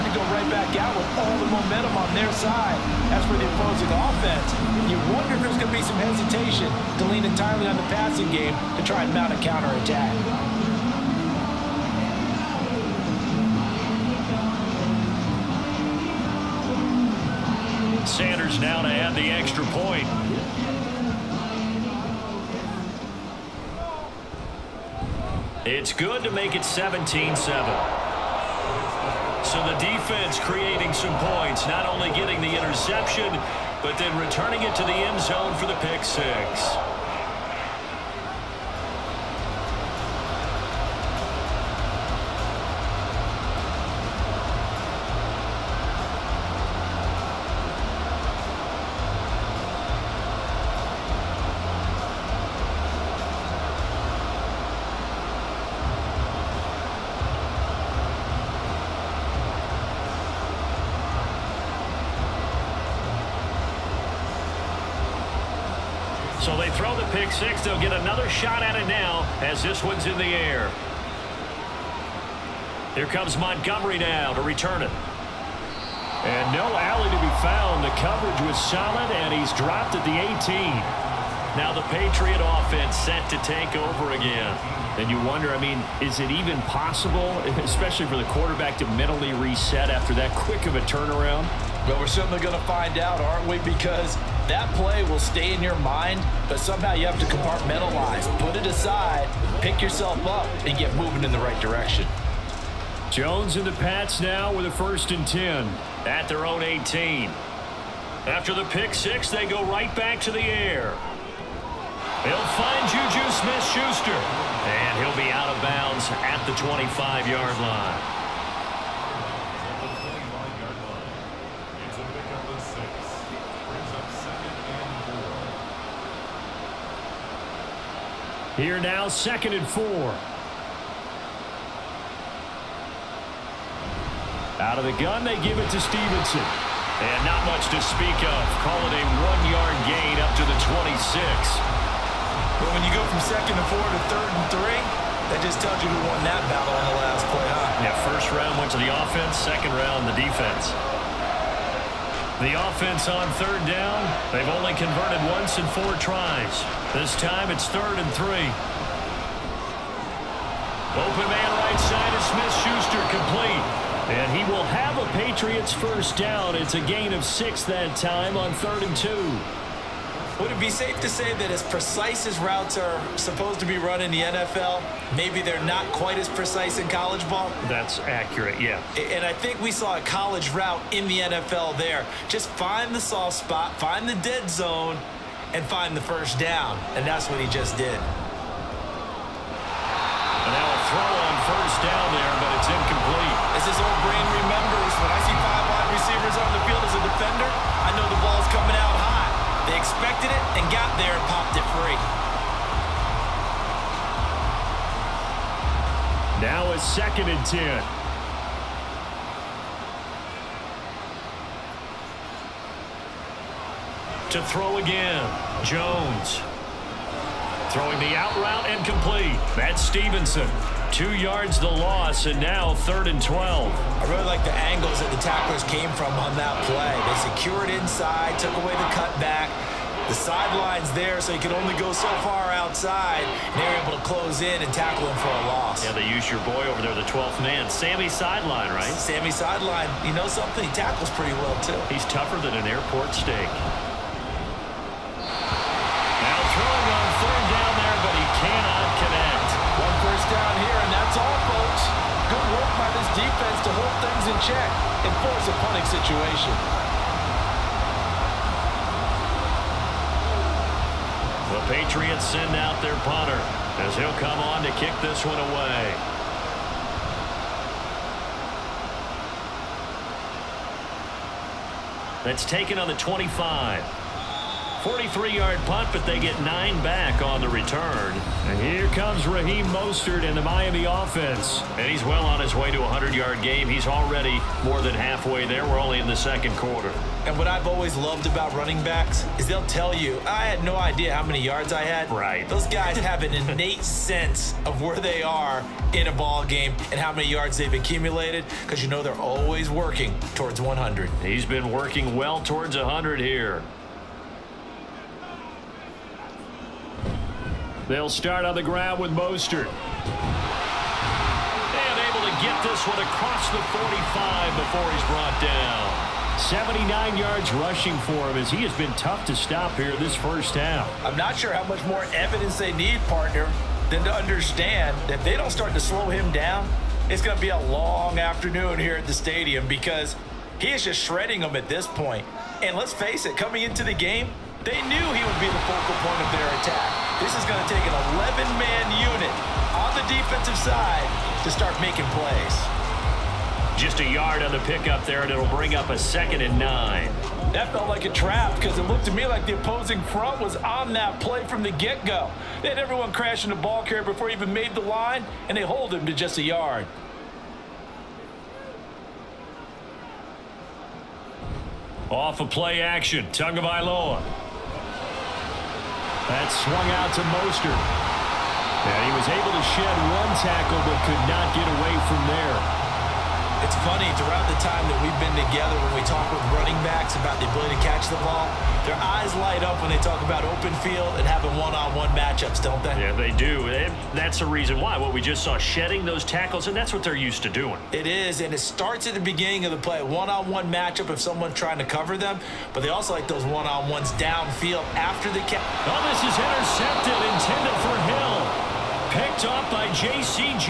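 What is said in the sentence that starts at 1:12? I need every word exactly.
Here comes Montgomery now to return it.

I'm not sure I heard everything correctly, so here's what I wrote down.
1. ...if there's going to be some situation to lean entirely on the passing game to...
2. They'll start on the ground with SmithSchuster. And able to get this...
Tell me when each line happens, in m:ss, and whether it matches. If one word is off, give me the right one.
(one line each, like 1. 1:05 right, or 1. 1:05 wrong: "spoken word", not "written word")
1. 0:05 wrong: "hesitation", not "situation"
2. 5:07 wrong: "Mostert", not "SmithSchuster".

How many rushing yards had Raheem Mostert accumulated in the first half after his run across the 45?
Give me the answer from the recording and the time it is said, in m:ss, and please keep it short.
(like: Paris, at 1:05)
79, at 5:16.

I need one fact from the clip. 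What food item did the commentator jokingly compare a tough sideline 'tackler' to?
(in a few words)
airport steak.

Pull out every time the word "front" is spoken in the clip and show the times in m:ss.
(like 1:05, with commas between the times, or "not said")
5:50.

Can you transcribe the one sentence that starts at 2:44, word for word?
And he will have a Patriots first down.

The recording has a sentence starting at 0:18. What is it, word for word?
Sanders now to add the extra point.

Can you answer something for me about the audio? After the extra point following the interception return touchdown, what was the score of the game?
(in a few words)
17-7.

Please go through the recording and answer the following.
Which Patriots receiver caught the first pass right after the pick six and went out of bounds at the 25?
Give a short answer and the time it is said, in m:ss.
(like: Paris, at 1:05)
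Juju Smith-Schuster, at 1:52.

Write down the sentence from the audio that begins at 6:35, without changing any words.
Oh, this is intercepted, intended for him picked off by J.C.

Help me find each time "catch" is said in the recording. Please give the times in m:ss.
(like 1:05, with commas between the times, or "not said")
6:17, 6:35.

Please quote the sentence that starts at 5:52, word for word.
They had everyone crashing the ball carrier before he even made the line, and they hold him to just a yard.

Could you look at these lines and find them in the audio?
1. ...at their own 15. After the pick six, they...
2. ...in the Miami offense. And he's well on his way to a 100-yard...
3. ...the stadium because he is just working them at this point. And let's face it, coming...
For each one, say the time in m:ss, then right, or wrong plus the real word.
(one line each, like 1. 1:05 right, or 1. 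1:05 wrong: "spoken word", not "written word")
1. 1:46 wrong: "18", not "15"
2. 4:40 right
3. 5:29 wrong: "shredding", not "working".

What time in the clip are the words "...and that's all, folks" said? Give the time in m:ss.
4:10.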